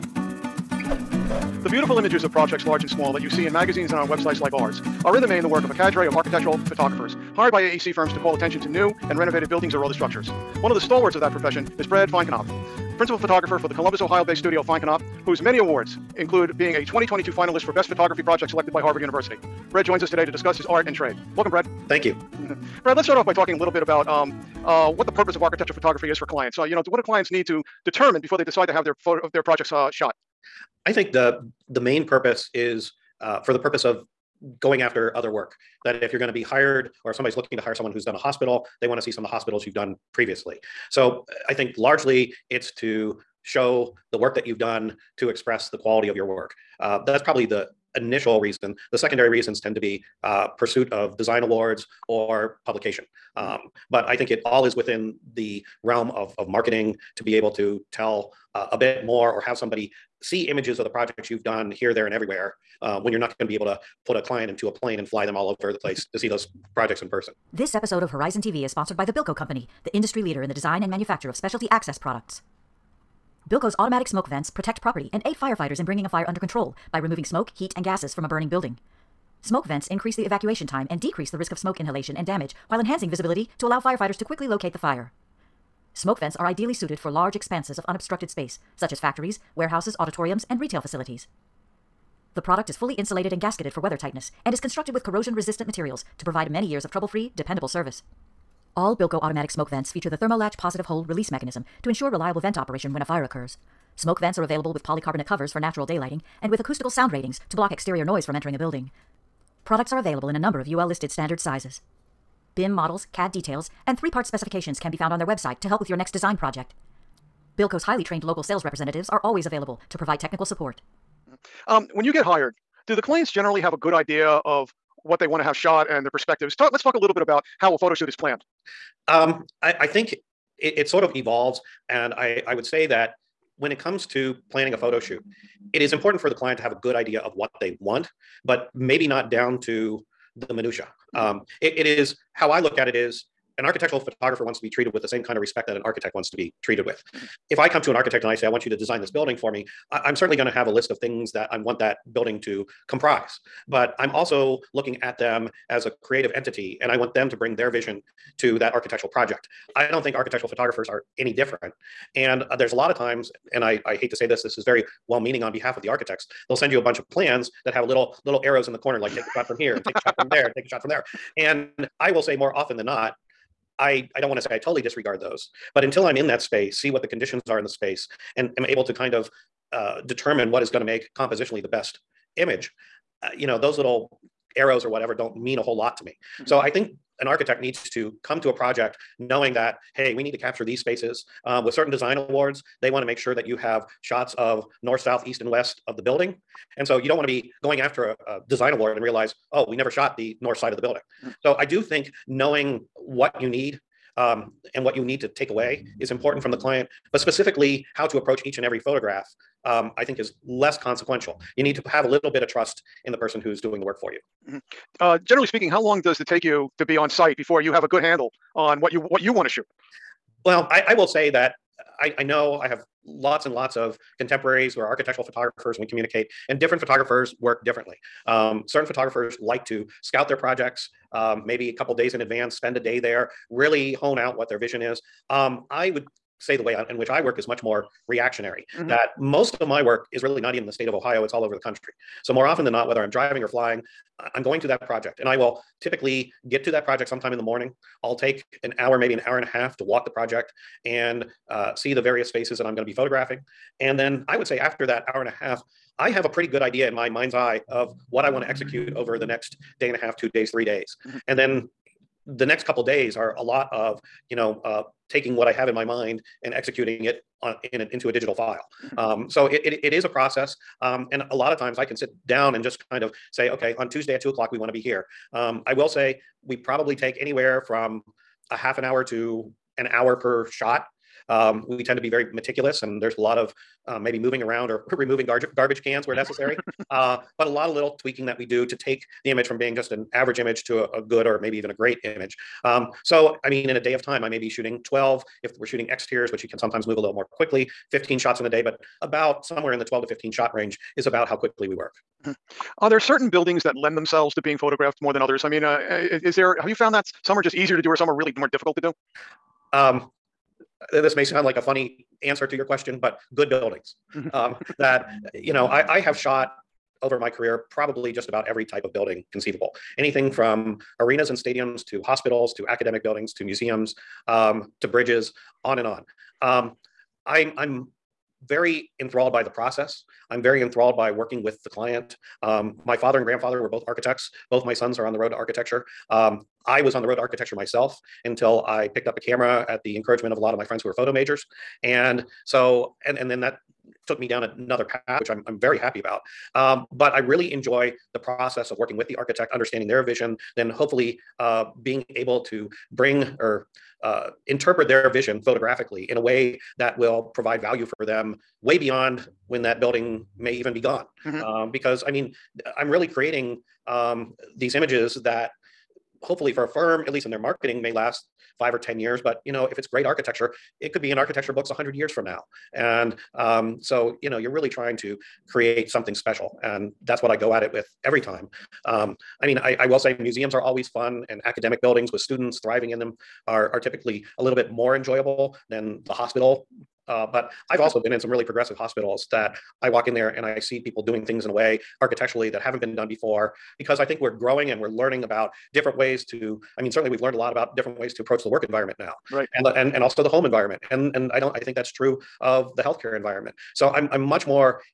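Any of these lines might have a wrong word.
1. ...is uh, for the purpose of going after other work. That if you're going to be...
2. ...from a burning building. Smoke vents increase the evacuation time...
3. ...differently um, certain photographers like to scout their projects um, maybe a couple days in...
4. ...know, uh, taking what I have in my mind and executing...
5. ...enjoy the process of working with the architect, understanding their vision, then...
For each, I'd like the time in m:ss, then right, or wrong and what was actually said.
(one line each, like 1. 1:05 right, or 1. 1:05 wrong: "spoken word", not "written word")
1. 0:32 right
2. 1:18 right
3. 3:47 right
4. 4:24 right
5. 5:47 right.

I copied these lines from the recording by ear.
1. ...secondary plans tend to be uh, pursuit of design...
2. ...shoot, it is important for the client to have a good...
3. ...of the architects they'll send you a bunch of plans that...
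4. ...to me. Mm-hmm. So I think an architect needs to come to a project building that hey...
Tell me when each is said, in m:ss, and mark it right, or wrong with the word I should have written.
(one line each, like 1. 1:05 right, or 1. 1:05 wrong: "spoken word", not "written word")
1. 0:48 wrong: "reasons", not "plans"
2. 2:14 right
3. 2:45 right
4. 3:05 wrong: "knowing", not "building".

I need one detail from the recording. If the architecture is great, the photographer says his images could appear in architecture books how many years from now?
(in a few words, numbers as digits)
100.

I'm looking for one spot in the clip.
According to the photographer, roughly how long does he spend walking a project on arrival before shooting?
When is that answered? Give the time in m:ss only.
4:09.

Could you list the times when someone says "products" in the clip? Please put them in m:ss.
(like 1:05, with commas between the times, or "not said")
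1:11, 1:32, 1:49.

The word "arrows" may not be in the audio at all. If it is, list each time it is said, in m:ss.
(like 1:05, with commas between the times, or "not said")
2:48, 3:04.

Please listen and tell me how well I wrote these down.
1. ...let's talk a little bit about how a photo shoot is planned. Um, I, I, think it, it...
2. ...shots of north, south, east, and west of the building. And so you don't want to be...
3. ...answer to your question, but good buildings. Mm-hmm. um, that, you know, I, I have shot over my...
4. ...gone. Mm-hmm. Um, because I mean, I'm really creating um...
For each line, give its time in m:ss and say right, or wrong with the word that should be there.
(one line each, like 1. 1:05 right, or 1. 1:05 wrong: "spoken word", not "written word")
1. 2:06 right
2. 3:14 right
3. 5:12 right
4. 6:00 right.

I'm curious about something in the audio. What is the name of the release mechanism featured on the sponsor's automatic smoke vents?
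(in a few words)
Thermolatch.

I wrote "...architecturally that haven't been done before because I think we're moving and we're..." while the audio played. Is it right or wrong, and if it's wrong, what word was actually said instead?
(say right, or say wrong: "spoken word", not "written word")
wrong: "growing", not "moving".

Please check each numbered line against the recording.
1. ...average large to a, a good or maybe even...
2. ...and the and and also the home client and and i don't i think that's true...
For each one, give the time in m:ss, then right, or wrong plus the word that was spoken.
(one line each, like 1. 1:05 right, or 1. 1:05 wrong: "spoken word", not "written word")
1. 4:50 wrong: "image", not "large"
2. 6:39 wrong: "environment", not "client".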